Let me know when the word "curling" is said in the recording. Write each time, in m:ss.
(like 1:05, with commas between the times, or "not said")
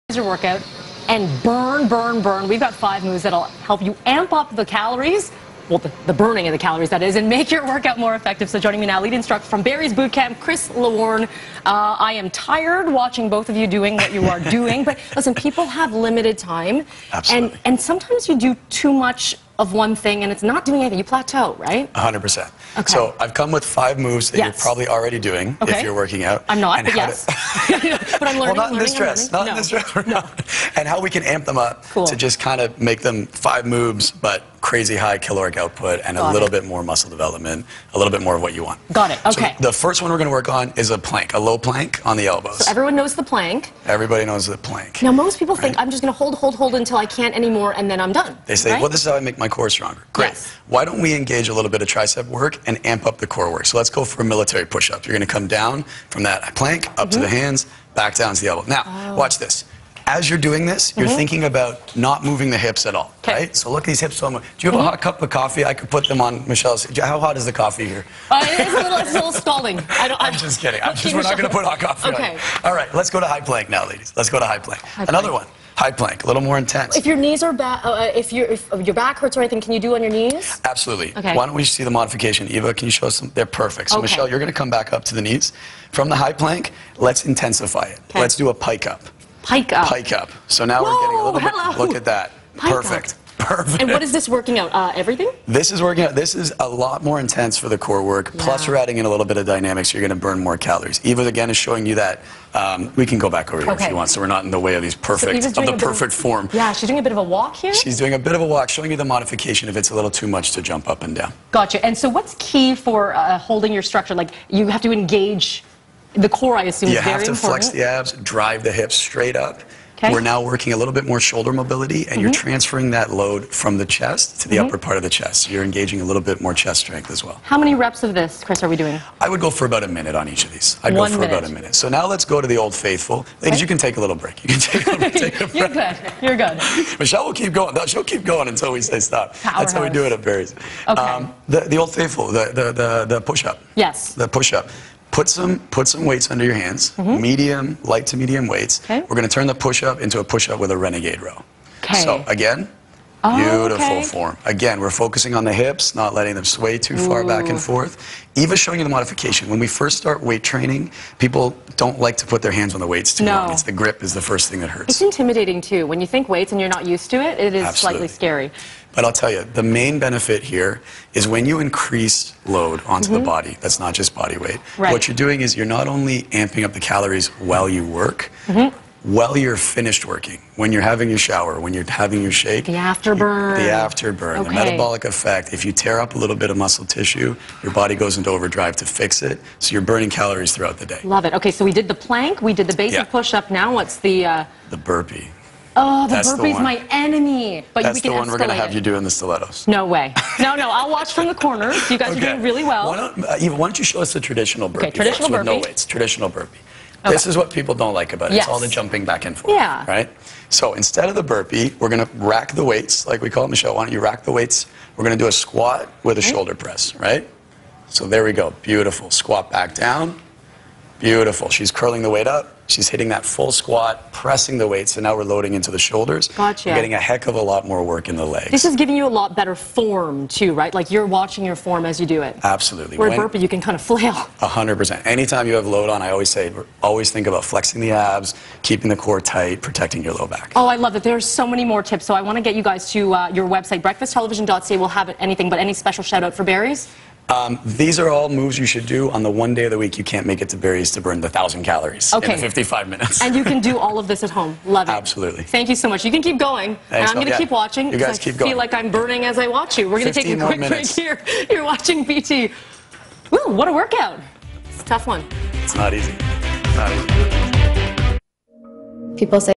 3:41.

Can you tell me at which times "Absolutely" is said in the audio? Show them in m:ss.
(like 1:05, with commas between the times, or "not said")
0:17, 1:20, 2:47, 3:52, 4:14.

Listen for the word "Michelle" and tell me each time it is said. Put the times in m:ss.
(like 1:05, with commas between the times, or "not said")
1:06, 1:24, 2:17, 3:33.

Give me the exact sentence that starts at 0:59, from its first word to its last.
watch this as you're doing this, you're mm -hmm.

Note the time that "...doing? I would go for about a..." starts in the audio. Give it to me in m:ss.
2:08.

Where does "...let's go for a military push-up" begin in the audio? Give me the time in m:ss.
0:53.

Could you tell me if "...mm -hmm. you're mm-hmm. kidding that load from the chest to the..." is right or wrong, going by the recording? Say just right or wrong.
wrong.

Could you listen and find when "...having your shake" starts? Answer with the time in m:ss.
3:01.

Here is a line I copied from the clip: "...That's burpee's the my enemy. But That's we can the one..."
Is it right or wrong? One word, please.
right.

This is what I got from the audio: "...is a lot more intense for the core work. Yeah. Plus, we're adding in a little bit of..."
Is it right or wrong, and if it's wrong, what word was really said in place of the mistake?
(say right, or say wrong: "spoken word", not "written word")
right.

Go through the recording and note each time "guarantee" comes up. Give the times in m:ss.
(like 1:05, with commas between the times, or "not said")
not said.